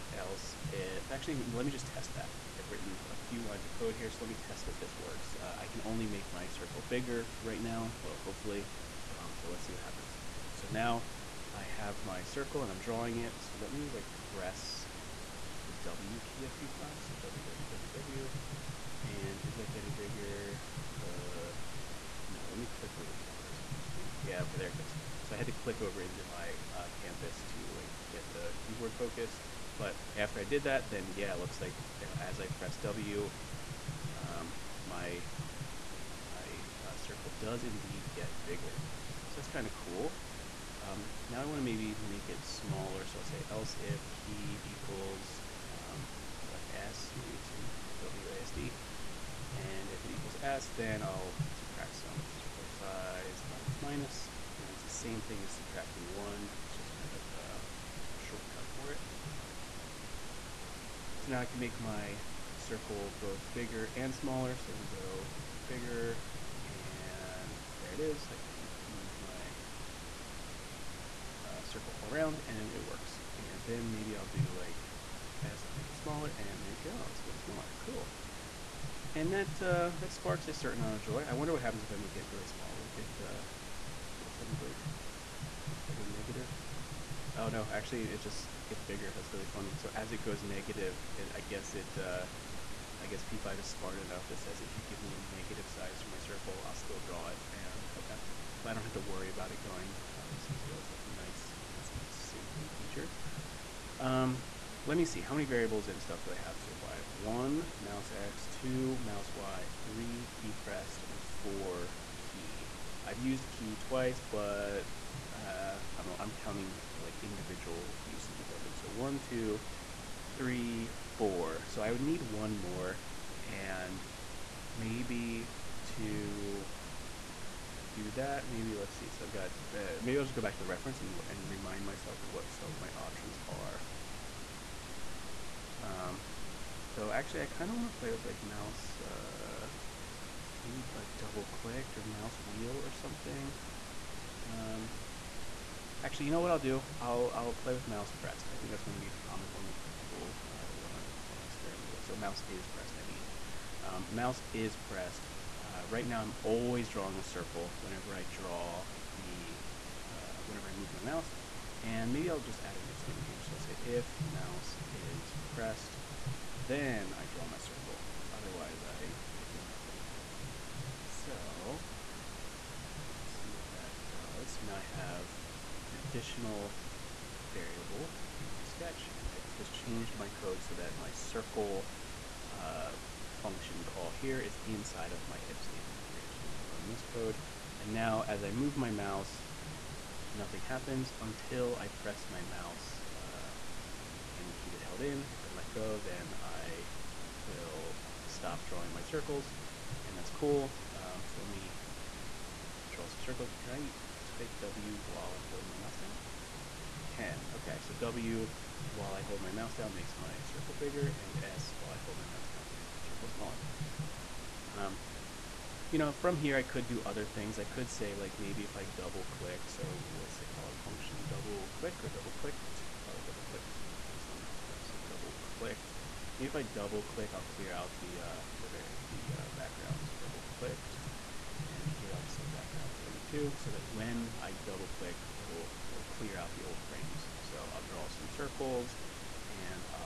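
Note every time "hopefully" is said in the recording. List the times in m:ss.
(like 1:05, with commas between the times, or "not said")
0:08.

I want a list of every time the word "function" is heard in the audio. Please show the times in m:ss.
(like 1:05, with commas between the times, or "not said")
3:03, 3:40.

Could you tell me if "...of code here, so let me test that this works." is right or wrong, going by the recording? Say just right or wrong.
right.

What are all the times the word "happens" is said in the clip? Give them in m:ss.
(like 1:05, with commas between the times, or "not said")
0:09, 1:21, 3:10.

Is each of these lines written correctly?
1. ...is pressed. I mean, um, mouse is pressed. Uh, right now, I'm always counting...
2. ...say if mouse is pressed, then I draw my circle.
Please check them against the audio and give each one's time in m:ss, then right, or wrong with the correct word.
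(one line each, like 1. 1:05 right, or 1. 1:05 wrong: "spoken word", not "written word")
1. 2:32 wrong: "drawing", not "counting"
2. 2:43 right.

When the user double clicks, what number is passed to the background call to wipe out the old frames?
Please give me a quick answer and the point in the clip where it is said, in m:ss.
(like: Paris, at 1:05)
32, at 3:52.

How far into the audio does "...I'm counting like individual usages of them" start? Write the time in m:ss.
1:56.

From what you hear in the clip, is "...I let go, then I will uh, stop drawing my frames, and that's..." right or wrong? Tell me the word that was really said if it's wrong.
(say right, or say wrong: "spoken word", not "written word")
wrong: "circles", not "frames".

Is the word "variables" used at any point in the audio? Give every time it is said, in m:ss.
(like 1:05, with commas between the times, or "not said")
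1:45, 2:57.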